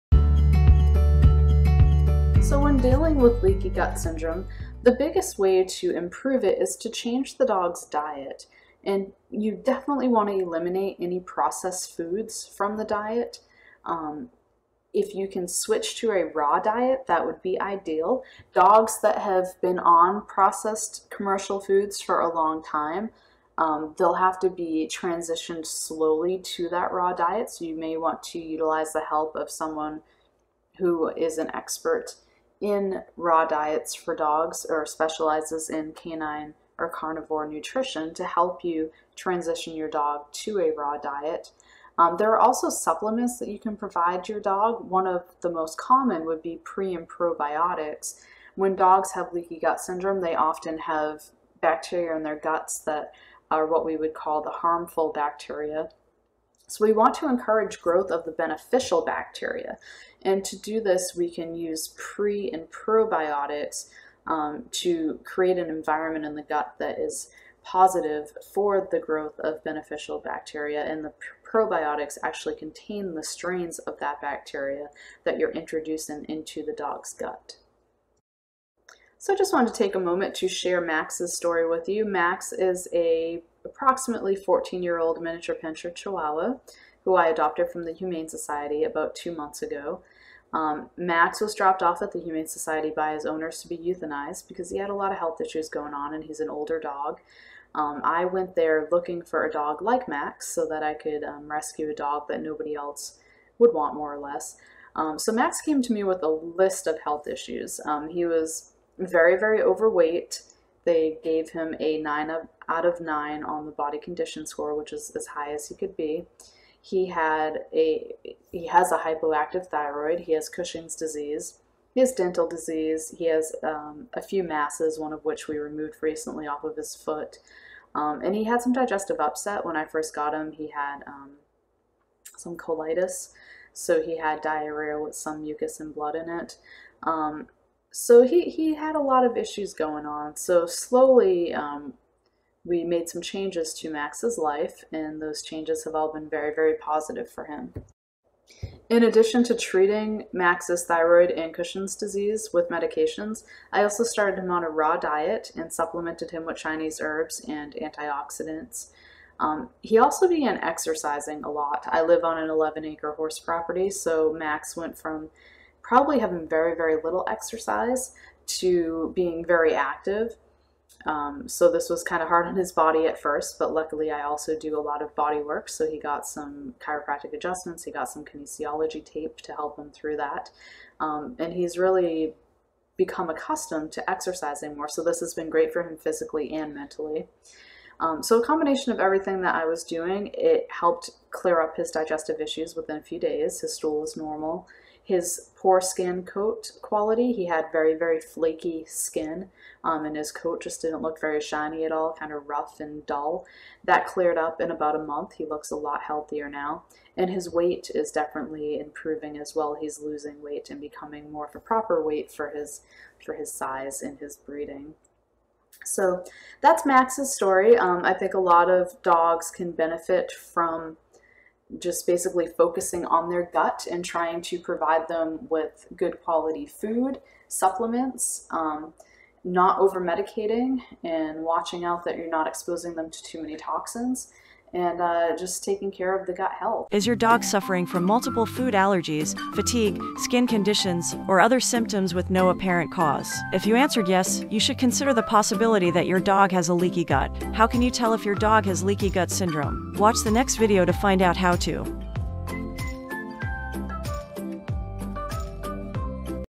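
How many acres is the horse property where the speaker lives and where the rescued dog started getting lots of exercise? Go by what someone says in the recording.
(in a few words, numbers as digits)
11.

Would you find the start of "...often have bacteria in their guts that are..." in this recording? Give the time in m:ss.
0:50.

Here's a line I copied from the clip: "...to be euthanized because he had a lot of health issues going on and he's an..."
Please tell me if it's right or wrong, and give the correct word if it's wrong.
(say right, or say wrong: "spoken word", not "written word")
right.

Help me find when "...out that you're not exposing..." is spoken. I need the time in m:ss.
3:51.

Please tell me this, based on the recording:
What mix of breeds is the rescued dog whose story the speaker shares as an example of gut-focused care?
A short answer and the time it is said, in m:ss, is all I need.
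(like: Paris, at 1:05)
Miniature pinscher chihuahua, at 1:25.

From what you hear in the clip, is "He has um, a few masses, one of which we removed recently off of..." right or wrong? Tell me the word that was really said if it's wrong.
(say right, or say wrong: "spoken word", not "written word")
right.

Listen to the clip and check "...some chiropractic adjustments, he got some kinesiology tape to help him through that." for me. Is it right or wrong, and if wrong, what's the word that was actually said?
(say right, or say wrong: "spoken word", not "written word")
right.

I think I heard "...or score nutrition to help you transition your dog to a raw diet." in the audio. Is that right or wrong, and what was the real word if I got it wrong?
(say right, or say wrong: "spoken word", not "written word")
wrong: "carnivore", not "score".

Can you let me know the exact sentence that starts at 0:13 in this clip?
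Um, if you can switch to a raw diet, that would be ideal.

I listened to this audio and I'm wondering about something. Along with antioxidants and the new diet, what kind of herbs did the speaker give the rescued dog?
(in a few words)
Chinese herbs.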